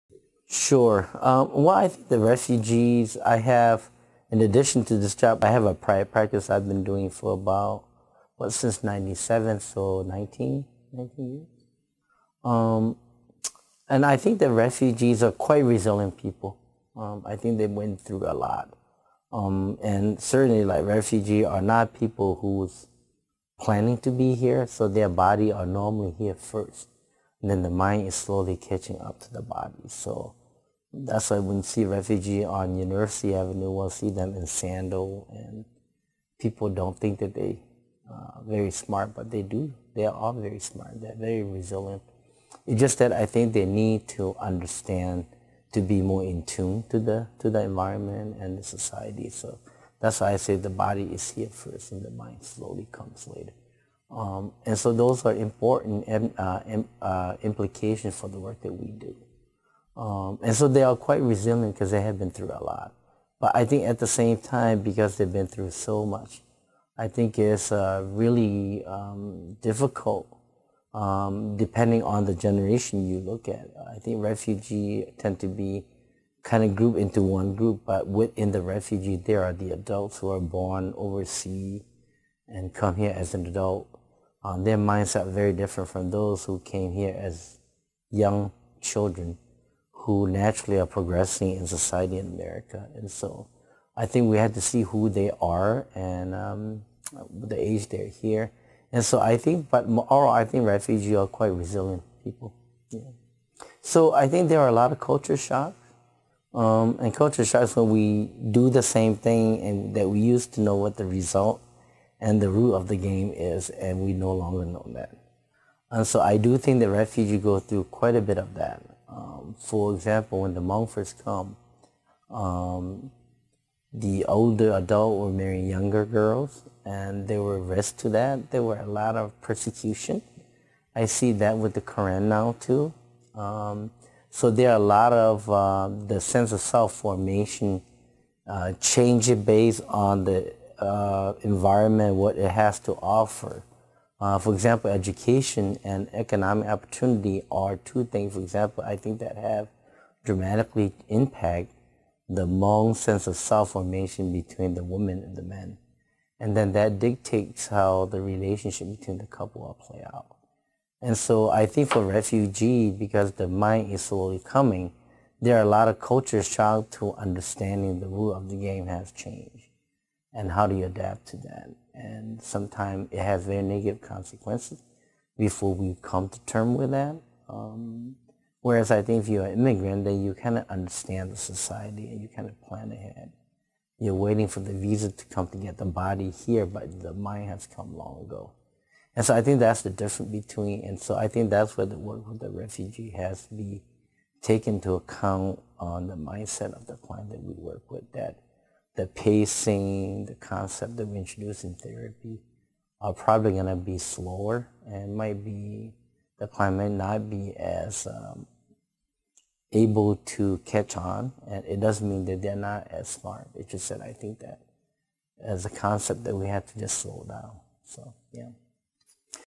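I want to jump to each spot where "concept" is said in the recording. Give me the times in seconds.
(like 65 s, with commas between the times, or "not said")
200 s, 215 s.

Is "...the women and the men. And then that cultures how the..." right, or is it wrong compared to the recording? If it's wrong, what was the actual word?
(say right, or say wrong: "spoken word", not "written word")
wrong: "dictates", not "cultures".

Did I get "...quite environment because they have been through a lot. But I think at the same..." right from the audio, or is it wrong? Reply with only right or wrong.
wrong.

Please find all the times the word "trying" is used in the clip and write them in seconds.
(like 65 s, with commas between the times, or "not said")
166 s.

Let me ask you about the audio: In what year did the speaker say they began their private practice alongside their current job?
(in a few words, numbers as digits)
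1997.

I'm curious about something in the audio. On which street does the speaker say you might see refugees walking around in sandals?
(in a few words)
University Avenue.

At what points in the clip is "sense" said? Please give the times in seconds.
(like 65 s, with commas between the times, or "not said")
136 s, 152 s.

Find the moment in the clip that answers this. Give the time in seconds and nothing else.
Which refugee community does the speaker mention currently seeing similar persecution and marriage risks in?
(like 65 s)
131 s.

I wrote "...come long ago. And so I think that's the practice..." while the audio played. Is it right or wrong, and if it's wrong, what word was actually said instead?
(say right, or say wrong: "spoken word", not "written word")
wrong: "difference", not "practice".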